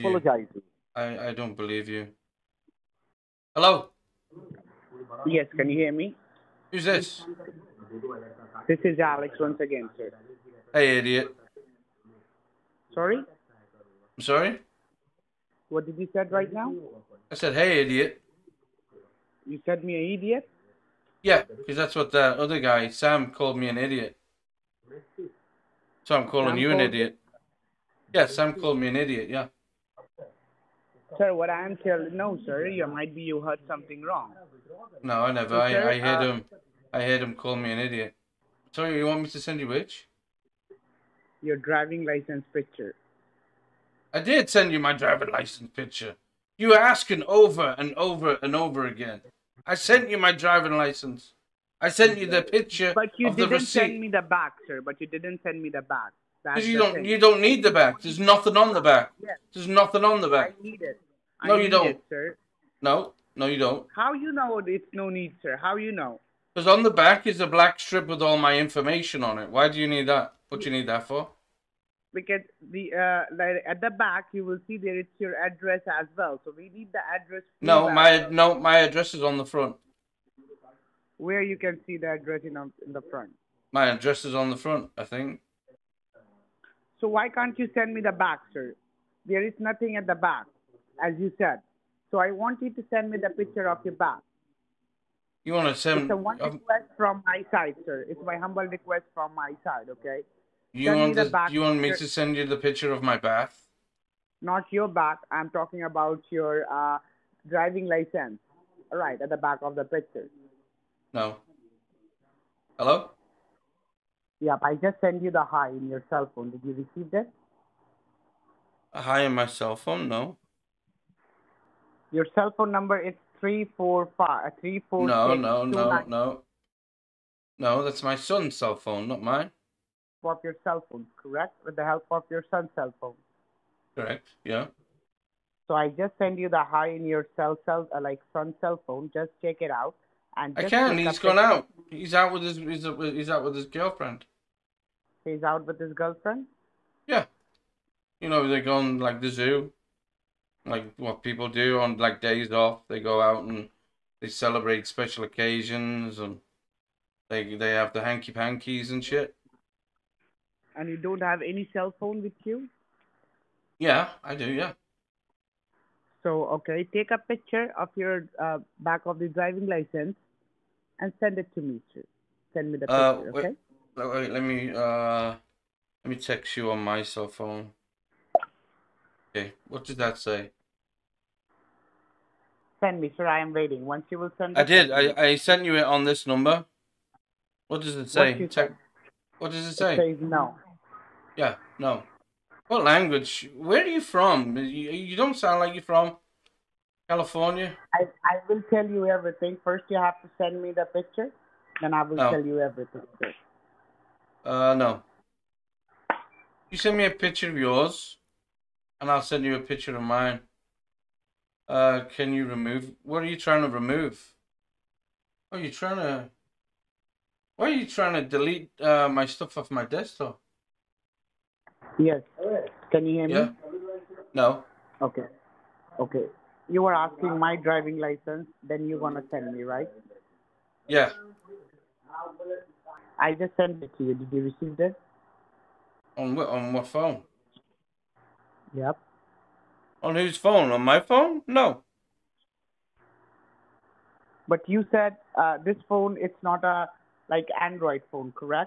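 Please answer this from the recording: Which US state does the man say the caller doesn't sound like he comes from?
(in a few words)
California.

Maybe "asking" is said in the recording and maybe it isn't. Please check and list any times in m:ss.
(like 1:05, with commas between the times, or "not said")
0:46, 3:46.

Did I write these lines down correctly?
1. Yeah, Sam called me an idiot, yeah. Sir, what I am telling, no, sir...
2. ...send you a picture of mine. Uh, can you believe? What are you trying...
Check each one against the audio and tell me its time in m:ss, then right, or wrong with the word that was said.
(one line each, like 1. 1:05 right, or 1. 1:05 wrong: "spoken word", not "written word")
1. 0:28 right
2. 3:29 wrong: "remove", not "believe".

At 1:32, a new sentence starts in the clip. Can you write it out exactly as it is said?
So I want you to send me the picture of your back.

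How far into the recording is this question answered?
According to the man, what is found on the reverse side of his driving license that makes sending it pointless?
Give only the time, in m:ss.
1:07.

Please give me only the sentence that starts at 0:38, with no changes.
Sorry, you want me to send you which?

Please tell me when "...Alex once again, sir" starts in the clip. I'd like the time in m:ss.
0:08.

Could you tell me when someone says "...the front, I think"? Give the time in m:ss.
1:24.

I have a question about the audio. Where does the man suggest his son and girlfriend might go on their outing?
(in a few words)
The zoo.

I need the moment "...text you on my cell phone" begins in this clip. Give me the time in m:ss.
2:56.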